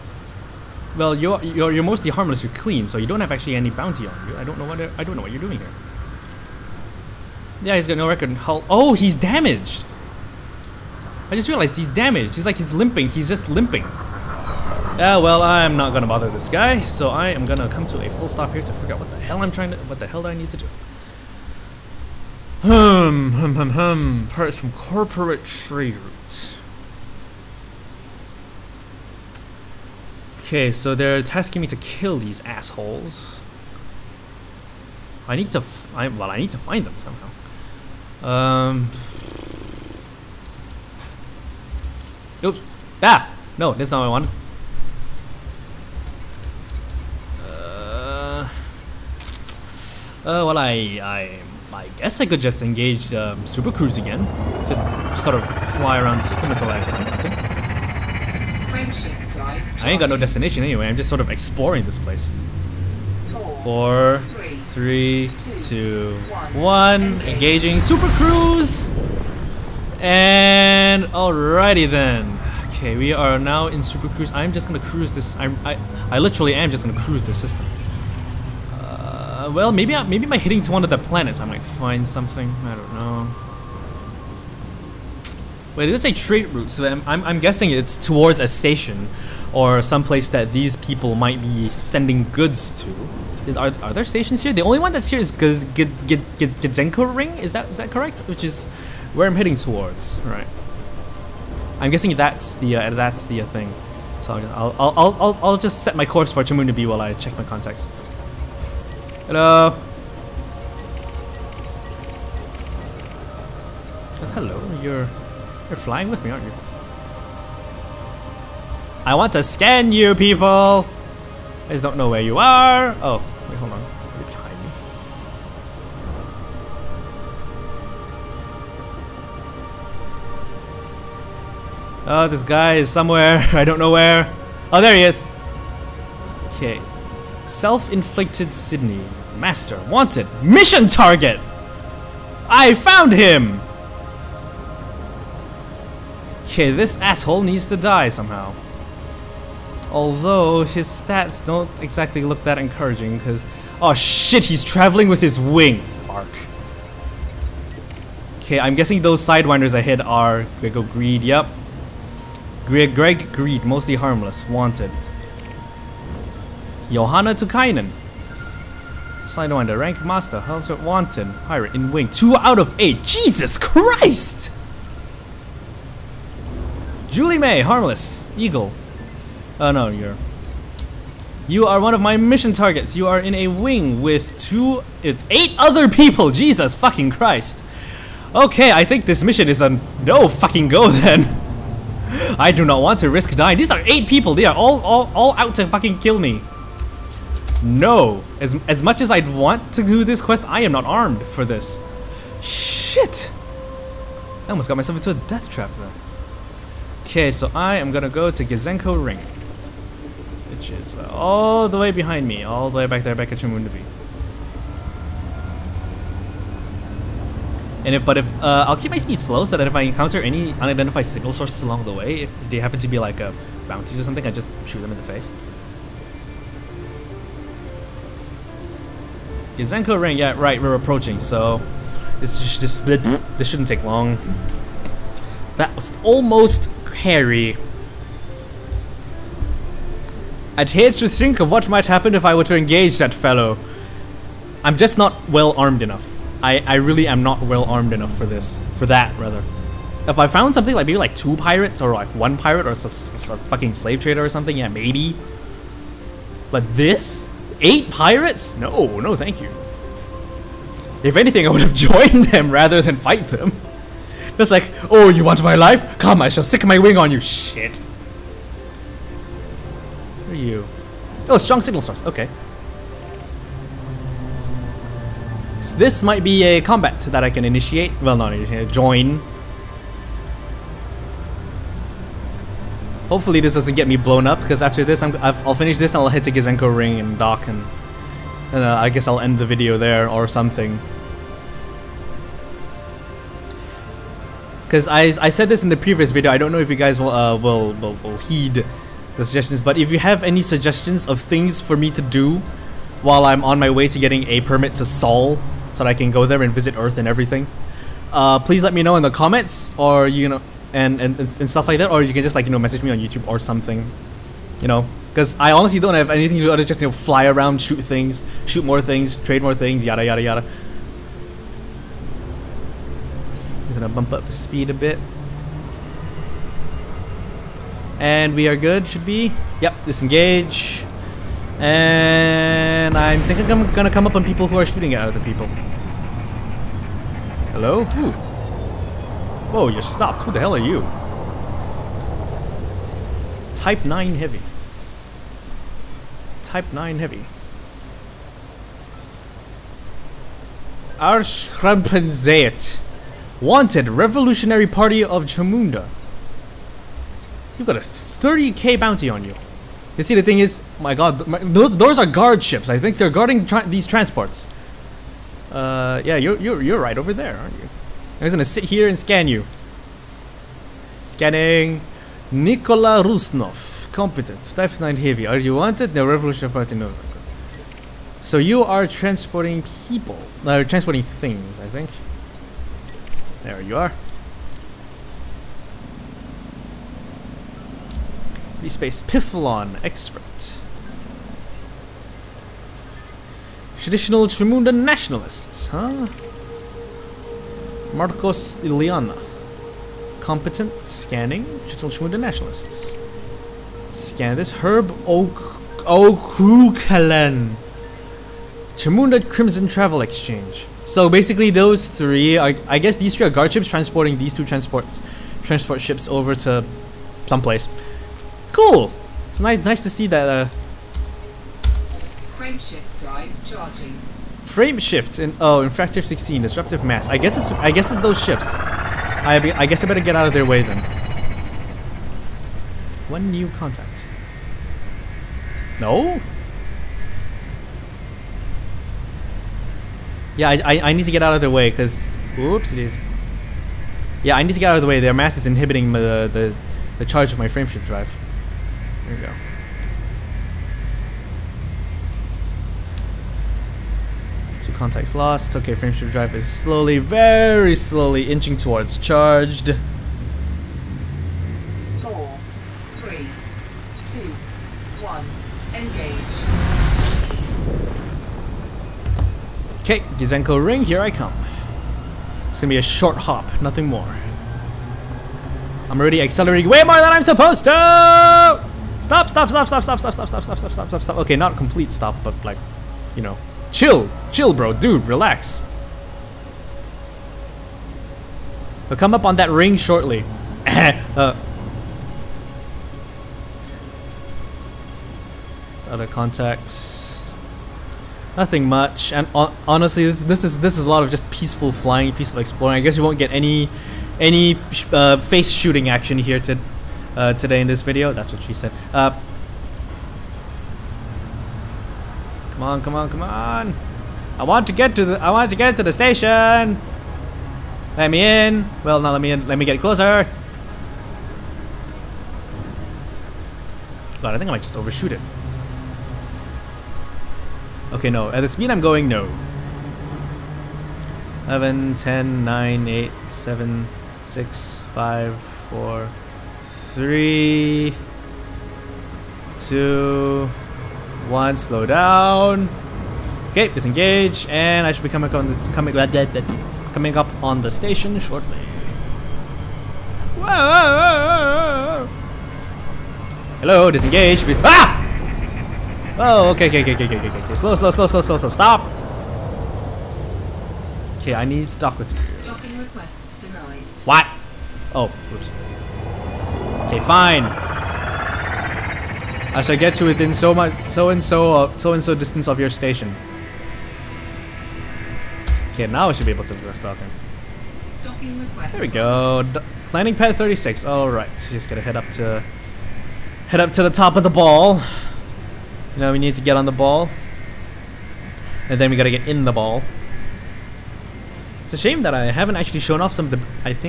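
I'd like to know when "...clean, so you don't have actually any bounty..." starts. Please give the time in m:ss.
0:02.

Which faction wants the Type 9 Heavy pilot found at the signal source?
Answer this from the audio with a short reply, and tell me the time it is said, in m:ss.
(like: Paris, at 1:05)
Revolutionary Party of Chamunda, at 5:53.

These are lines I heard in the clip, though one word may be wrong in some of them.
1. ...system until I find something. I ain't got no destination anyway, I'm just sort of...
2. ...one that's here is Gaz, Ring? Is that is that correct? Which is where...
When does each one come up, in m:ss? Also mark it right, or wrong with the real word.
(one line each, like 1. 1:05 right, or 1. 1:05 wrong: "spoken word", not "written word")
1. 0:56 right
2. 1:34 right.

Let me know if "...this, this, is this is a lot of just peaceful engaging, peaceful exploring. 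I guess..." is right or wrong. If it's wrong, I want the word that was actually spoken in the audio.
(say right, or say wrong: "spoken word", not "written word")
wrong: "flying", not "engaging".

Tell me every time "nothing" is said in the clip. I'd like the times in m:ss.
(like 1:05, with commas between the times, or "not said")
7:53, 8:18.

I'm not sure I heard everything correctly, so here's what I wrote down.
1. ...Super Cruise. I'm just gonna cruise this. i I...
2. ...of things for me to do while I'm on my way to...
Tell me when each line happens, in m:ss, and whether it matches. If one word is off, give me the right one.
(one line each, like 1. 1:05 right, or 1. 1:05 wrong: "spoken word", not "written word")
1. 1:13 right
2. 5:01 right.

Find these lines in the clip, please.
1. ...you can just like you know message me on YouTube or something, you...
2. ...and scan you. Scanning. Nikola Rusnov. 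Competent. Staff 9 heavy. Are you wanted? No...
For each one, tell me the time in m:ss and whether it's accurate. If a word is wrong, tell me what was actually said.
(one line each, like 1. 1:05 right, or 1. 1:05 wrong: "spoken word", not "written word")
1. 5:12 right
2. 6:08 right.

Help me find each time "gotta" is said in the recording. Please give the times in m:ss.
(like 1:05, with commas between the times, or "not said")
9:41, 9:48.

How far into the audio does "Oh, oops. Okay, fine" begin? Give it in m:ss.
9:24.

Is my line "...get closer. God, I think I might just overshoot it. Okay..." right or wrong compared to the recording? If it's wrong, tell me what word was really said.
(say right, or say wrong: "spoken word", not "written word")
right.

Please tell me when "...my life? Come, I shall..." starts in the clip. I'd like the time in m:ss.
4:25.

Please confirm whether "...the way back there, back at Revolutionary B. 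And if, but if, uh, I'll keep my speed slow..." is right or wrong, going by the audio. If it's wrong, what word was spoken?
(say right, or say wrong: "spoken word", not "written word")
wrong: "Chamunda", not "Revolutionary".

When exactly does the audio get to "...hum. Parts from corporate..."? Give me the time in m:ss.
0:23.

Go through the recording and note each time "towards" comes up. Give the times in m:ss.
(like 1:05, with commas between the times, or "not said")
1:27, 1:39, 7:38.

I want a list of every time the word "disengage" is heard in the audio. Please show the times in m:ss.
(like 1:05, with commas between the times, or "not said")
5:29, 9:03, 9:13.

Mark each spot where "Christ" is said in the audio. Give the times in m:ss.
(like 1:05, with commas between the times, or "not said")
2:53, 3:07.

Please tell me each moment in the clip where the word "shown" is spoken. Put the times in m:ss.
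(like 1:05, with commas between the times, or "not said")
9:52.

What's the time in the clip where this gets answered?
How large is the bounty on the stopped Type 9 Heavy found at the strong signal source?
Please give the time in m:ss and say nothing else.
5:57.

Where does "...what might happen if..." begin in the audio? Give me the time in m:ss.
4:01.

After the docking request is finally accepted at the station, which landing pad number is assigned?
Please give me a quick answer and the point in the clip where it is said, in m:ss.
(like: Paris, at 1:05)
36, at 9:40.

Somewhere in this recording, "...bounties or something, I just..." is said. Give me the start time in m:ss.
3:43.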